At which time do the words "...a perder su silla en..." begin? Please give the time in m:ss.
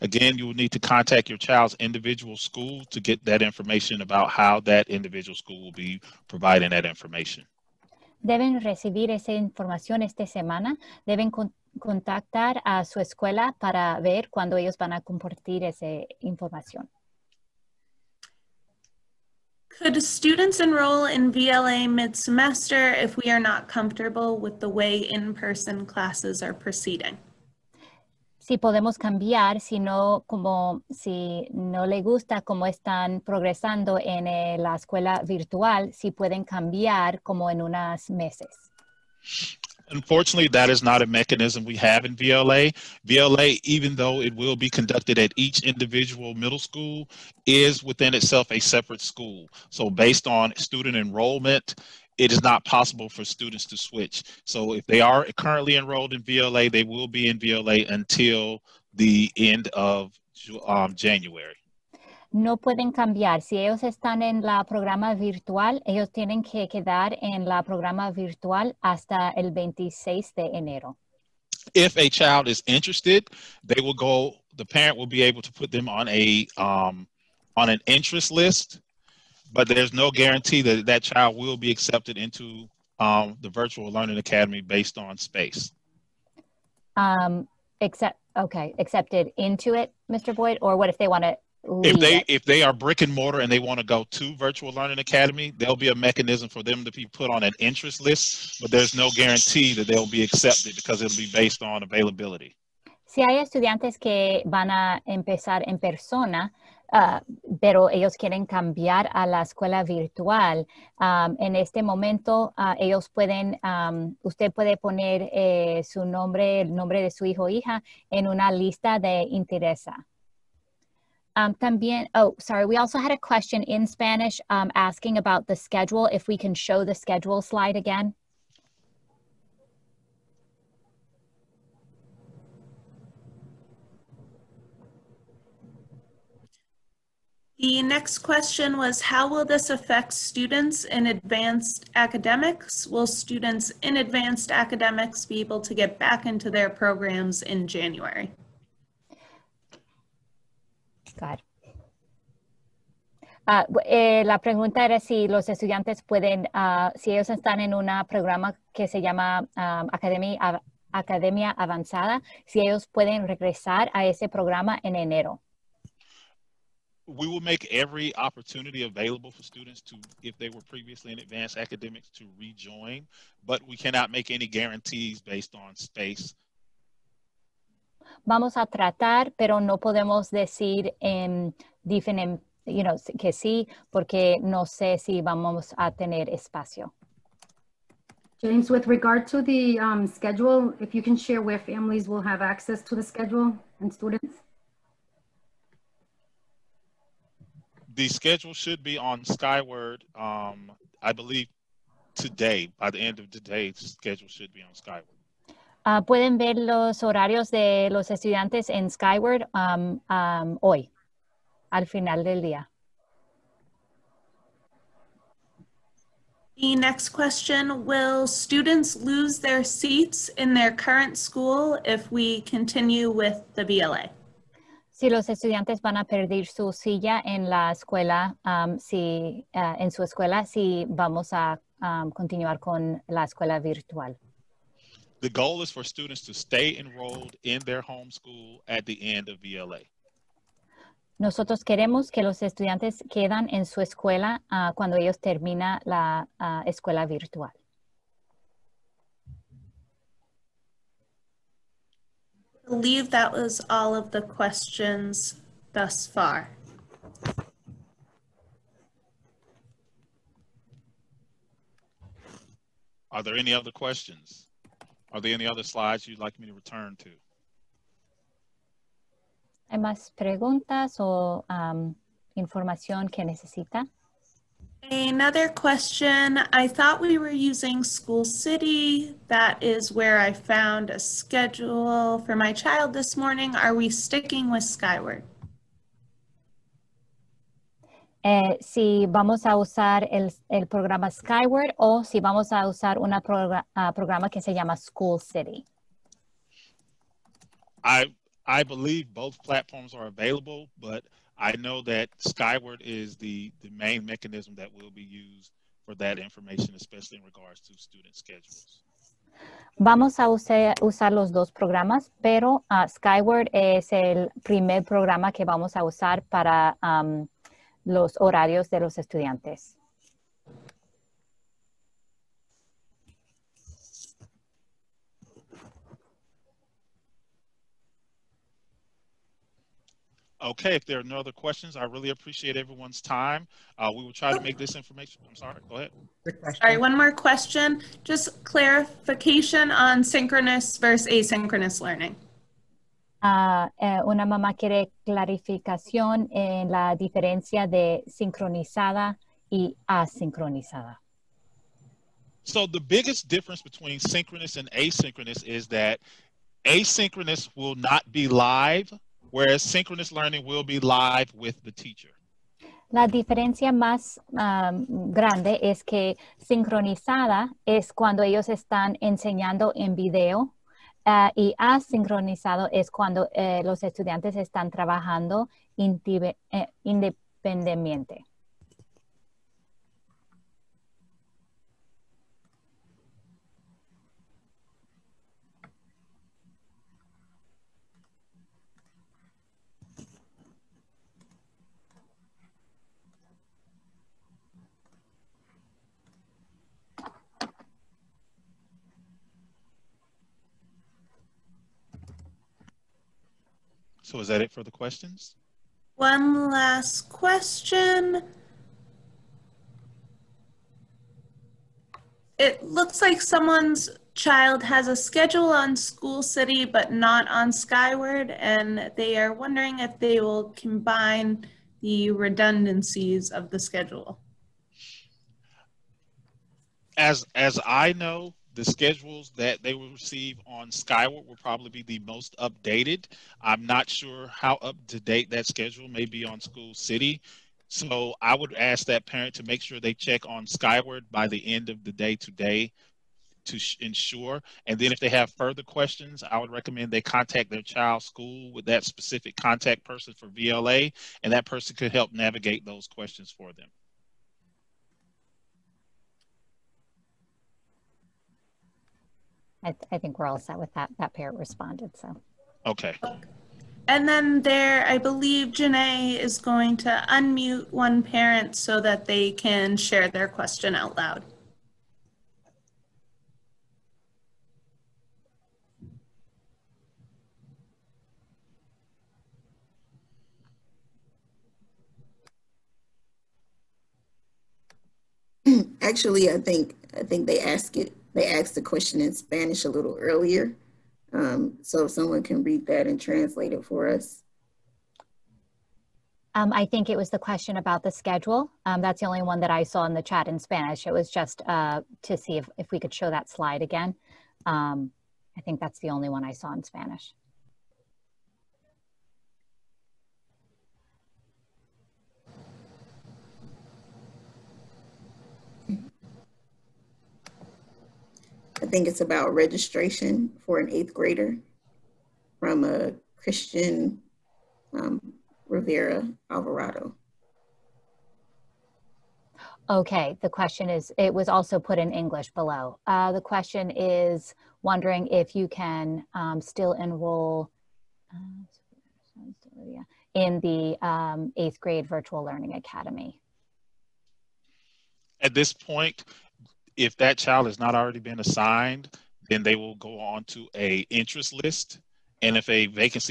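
3:45.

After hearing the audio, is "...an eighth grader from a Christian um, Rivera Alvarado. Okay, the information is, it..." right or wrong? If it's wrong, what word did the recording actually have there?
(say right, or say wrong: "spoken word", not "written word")
wrong: "question", not "information".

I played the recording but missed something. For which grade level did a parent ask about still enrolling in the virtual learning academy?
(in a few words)
eighth grade.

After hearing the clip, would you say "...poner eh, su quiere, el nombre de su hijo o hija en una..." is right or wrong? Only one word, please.
wrong.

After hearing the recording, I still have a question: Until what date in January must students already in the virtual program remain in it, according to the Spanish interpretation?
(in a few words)
January 26.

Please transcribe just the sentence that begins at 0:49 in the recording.
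So based on student enrollment it is not possible for students to switch.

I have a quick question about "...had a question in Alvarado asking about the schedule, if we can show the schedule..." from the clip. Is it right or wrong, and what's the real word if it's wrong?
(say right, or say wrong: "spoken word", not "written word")
wrong: "Spanish", not "Alvarado".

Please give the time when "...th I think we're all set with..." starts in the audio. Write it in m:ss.
7:39.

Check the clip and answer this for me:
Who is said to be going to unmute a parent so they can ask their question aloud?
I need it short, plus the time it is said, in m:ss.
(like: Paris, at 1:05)
Janae, at 7:45.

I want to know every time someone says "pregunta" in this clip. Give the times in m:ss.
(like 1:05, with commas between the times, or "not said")
2:34, 4:30.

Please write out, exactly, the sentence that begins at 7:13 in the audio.
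I'm not sure how up to date that schedule may be on School City.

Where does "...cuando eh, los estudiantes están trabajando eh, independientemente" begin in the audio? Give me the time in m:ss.
6:12.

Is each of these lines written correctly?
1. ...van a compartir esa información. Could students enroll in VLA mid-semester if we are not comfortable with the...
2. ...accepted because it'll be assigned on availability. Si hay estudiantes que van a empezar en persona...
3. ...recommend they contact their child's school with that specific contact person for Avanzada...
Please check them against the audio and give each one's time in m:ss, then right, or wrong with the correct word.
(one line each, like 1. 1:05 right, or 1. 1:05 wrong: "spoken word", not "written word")
1. 0:14 right
2. 1:40 wrong: "based", not "assigned"
3. 7:26 wrong: "VLA", not "Avanzada".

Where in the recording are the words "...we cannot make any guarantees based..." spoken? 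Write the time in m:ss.
2:53.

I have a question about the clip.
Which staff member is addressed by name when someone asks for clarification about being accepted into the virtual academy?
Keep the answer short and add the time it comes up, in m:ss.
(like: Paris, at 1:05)
Mr. Boyd, at 1:30.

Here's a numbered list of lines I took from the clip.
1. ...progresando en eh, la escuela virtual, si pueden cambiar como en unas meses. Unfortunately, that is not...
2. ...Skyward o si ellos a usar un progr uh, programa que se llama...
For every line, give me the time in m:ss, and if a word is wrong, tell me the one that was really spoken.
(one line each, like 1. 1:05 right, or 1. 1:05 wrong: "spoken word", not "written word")
1. 0:33 right
2. 4:51 wrong: "vamos", not "ellos".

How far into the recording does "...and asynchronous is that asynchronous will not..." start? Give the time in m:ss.
5:54.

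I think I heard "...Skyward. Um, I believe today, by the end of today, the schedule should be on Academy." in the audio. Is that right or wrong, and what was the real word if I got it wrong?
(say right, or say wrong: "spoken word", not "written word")
wrong: "Skyward", not "Academy".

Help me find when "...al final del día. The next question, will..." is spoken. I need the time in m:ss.
3:31.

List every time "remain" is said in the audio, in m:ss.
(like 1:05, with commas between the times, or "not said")
not said.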